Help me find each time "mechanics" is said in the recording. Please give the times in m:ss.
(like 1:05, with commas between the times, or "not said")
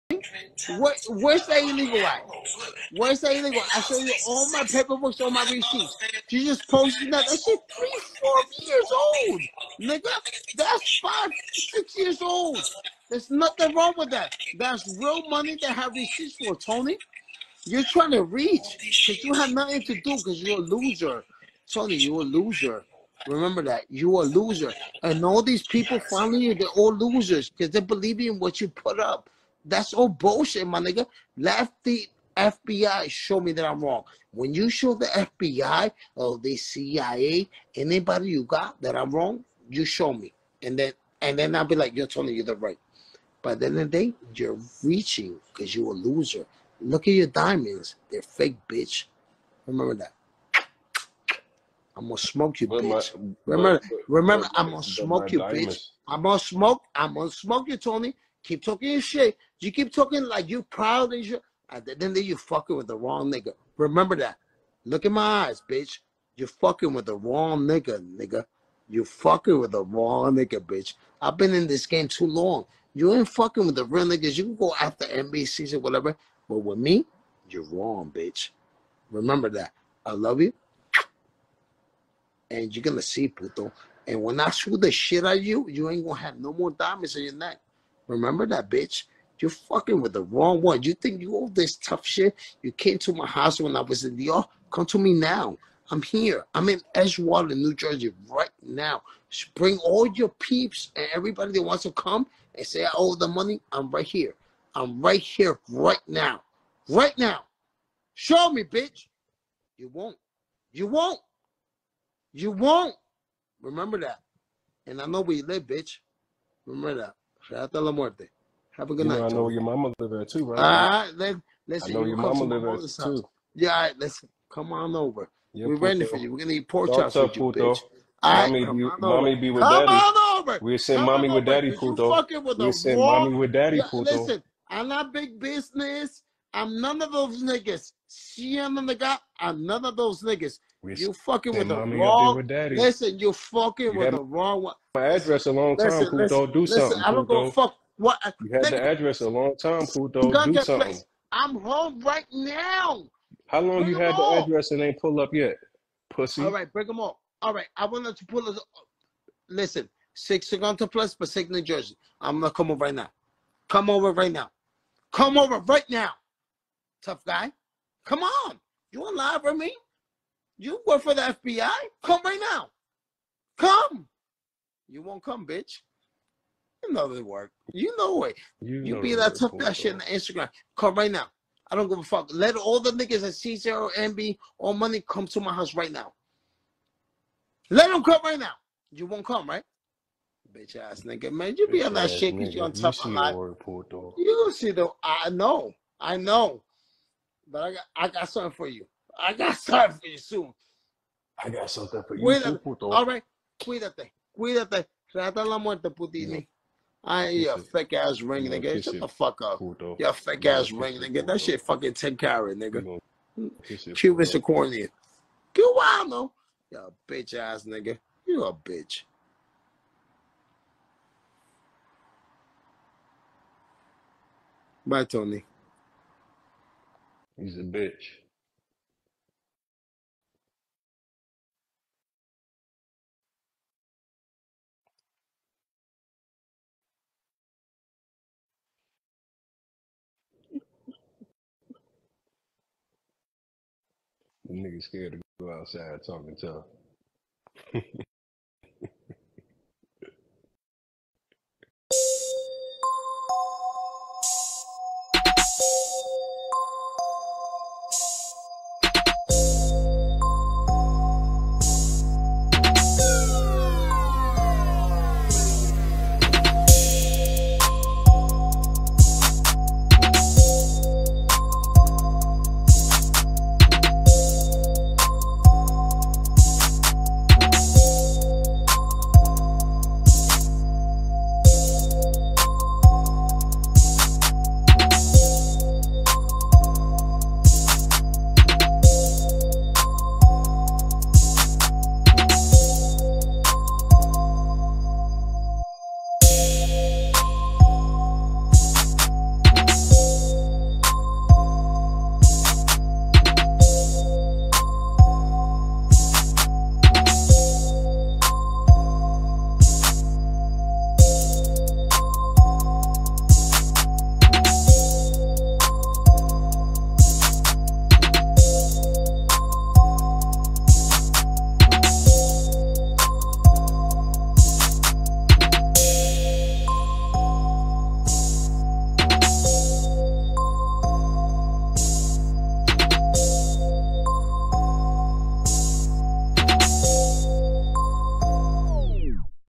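not said.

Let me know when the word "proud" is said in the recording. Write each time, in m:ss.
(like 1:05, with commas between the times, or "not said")
1:00.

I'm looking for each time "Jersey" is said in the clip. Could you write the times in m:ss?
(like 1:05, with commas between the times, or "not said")
1:37, 2:41.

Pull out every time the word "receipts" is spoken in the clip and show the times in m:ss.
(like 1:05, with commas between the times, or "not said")
0:05, 0:15.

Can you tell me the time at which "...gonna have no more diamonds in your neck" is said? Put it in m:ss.
1:26.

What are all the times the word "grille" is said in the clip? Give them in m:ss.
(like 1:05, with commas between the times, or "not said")
not said.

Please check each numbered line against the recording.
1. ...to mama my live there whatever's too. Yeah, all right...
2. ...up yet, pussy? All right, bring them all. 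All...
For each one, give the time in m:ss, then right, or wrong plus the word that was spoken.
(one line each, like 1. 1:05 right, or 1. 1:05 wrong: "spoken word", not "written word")
1. 2:02 wrong: "mother", not "whatever"
2. 2:35 right.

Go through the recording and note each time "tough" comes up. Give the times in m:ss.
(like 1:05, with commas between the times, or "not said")
1:31, 2:47, 2:59, 4:06.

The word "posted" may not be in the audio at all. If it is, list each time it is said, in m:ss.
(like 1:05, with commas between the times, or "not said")
0:06.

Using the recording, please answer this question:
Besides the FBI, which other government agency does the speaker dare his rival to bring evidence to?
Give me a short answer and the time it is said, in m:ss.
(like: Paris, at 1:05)
CIA, at 0:36.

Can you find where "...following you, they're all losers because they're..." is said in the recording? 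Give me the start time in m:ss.
0:25.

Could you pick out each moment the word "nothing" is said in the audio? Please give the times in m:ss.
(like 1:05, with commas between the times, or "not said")
0:13, 0:19.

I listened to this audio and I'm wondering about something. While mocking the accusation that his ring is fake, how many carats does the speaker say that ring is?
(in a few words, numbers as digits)
10.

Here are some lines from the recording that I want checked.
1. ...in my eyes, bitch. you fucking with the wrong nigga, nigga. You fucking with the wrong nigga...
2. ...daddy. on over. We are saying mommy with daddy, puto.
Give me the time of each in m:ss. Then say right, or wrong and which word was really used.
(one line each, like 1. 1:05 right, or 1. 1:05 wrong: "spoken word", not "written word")
1. 1:05 right
2. 2:09 right.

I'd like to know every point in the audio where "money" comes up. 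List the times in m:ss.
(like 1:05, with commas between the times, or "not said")
0:15, 1:43, 3:04.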